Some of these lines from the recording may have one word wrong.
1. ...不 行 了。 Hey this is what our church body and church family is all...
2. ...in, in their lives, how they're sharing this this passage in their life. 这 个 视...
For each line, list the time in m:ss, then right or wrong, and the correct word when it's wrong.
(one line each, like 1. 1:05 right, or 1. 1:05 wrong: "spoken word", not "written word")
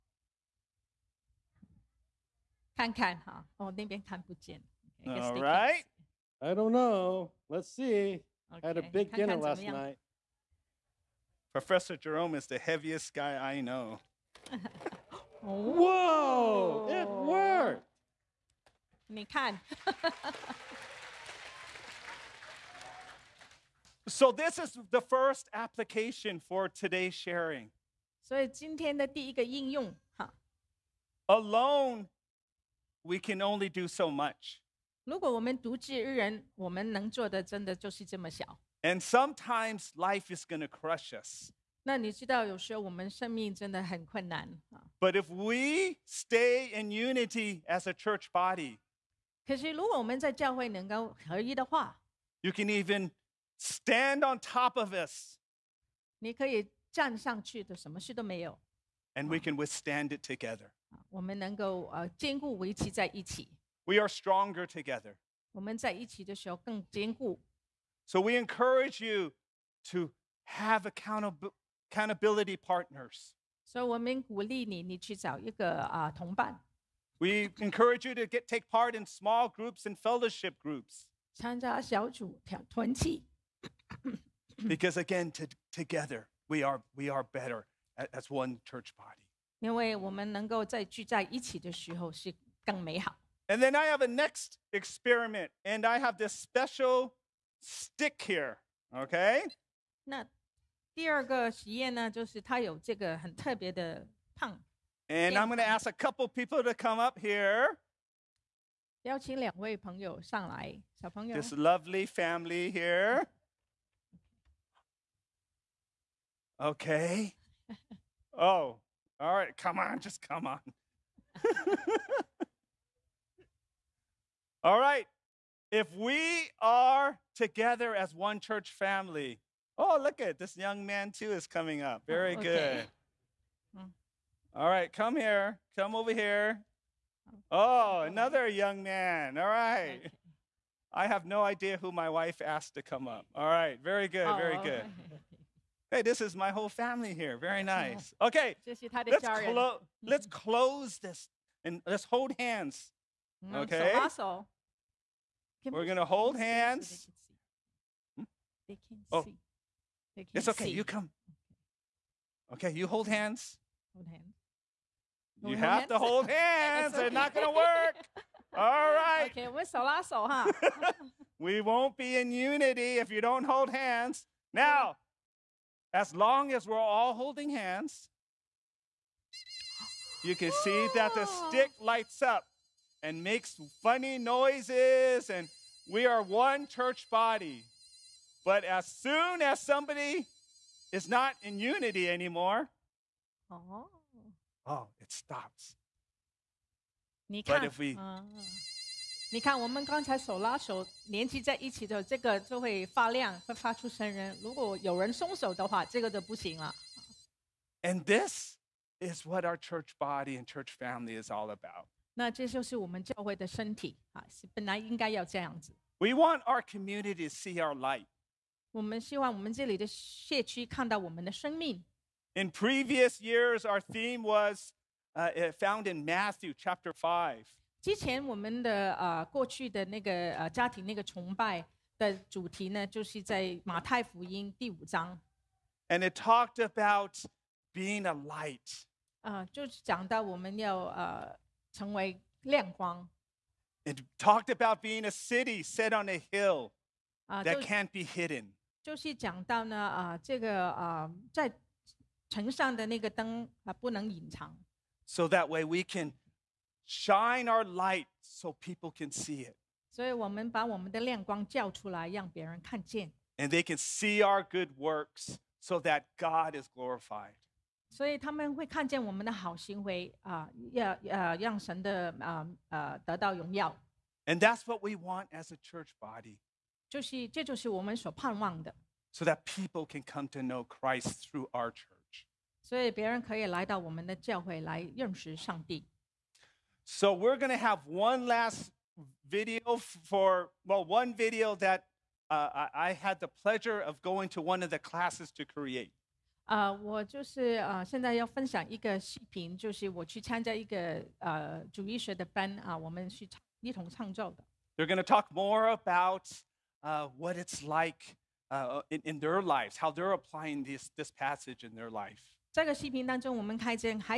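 1. 3:26 wrong: "And", not "Hey"
2. 5:08 wrong: "applying", not "sharing".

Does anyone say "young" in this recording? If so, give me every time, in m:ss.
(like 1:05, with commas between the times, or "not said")
2:10, 2:18.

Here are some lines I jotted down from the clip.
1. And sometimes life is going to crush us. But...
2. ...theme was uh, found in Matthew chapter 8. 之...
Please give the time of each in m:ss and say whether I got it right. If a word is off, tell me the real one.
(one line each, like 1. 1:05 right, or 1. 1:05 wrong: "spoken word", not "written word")
1. 0:38 right
2. 3:43 wrong: "5", not "8".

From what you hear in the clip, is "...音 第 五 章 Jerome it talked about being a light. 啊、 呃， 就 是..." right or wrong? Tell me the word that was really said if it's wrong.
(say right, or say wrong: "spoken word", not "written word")
wrong: "And", not "Jerome".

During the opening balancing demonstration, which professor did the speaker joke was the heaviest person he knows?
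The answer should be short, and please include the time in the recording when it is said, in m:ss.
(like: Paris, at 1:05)
Professor Jerome, at 0:11.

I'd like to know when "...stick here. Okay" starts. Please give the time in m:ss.
1:37.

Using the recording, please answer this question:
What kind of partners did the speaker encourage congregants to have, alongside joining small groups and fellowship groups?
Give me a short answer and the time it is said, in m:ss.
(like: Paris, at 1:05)
accountability partners, at 1:11.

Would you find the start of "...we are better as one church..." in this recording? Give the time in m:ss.
1:26.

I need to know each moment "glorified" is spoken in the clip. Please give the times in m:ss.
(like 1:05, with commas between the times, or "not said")
4:26.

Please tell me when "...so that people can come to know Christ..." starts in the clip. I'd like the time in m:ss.
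4:39.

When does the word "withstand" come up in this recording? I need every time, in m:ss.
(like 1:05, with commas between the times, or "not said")
0:59.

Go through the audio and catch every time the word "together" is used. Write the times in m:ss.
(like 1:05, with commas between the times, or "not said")
1:00, 1:04, 1:25, 2:07.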